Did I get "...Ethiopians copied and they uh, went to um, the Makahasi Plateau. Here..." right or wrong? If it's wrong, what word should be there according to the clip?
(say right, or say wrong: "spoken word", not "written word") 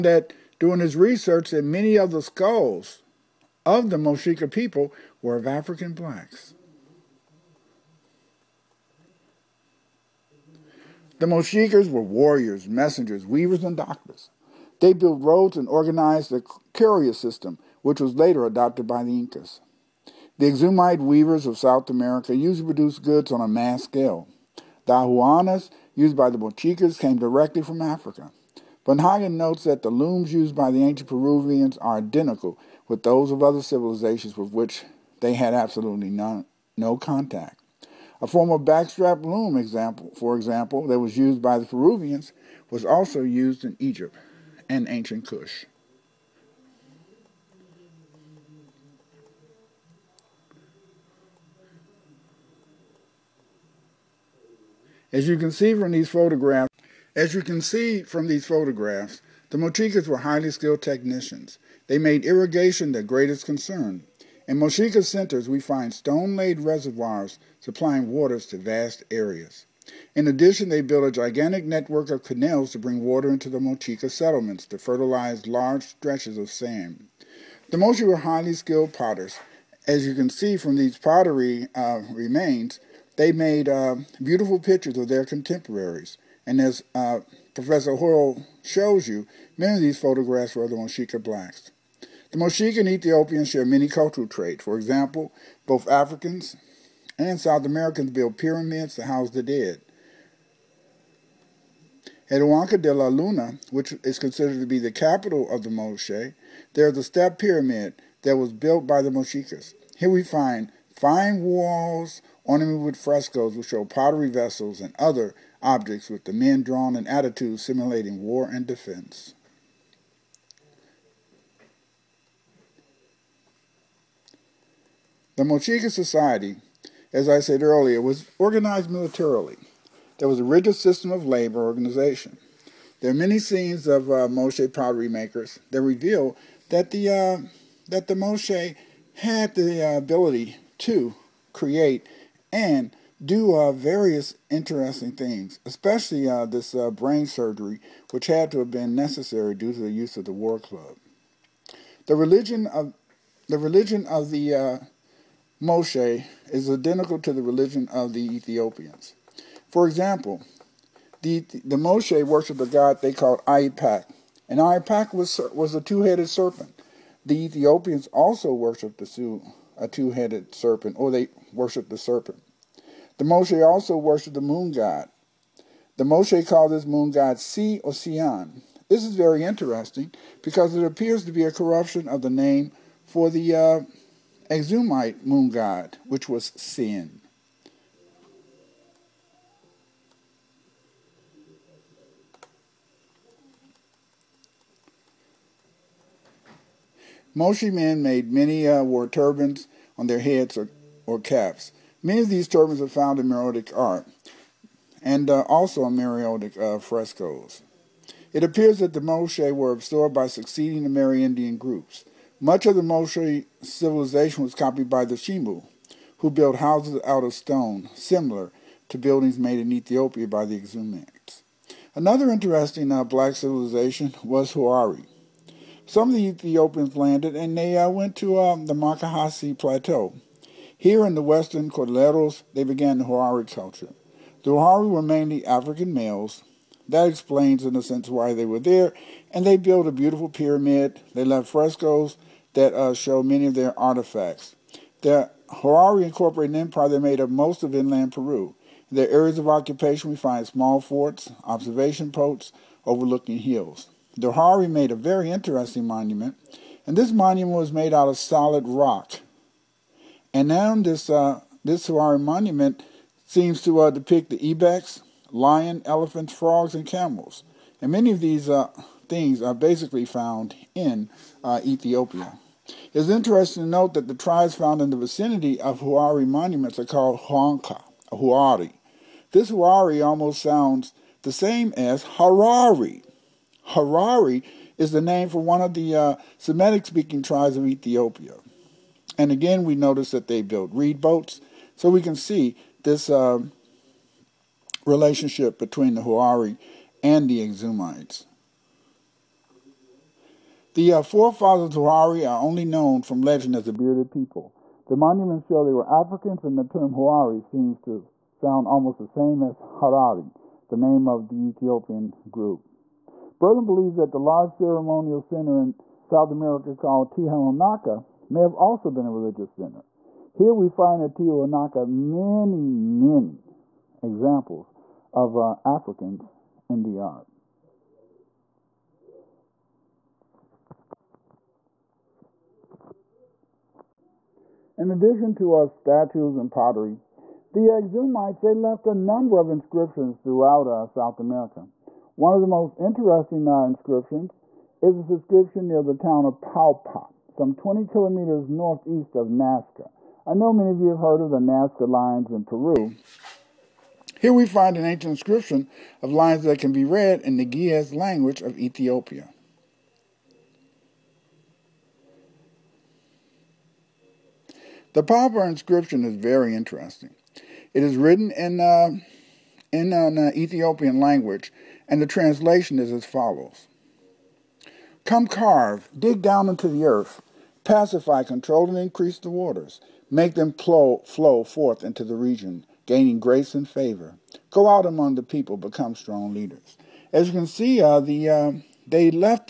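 wrong: "landed", not "copied".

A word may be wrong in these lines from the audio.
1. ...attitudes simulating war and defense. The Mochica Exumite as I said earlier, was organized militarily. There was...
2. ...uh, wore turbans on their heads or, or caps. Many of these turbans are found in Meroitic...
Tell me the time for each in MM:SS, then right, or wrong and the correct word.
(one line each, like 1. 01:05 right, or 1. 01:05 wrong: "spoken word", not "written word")
1. 01:57 wrong: "Society", not "Exumite"
2. 03:18 right.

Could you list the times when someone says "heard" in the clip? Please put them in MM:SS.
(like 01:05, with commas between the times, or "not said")
05:50.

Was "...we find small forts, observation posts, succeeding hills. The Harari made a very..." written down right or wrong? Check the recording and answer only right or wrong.
wrong.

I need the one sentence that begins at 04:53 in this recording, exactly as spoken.
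Um, relationship between the Huari and the Exumites.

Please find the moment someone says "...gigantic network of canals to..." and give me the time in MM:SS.
01:11.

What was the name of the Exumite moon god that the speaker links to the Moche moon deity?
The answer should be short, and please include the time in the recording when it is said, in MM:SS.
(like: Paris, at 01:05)
Sin, at 03:06.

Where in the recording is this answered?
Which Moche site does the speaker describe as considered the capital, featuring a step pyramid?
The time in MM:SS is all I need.
01:42.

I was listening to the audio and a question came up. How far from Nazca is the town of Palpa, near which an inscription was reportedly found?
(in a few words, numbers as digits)
20 kilometers.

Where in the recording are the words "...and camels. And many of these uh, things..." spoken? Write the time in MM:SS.
04:26.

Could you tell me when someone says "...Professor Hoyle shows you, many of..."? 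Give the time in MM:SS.
01:27.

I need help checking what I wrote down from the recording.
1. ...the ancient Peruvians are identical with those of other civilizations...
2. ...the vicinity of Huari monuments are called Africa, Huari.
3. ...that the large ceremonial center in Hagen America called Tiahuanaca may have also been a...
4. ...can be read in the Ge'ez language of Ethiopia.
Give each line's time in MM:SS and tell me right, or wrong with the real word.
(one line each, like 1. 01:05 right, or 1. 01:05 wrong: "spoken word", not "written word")
1. 00:30 right
2. 04:34 wrong: "Huanka", not "Africa"
3. 05:13 wrong: "South", not "Hagen"
4. 05:56 right.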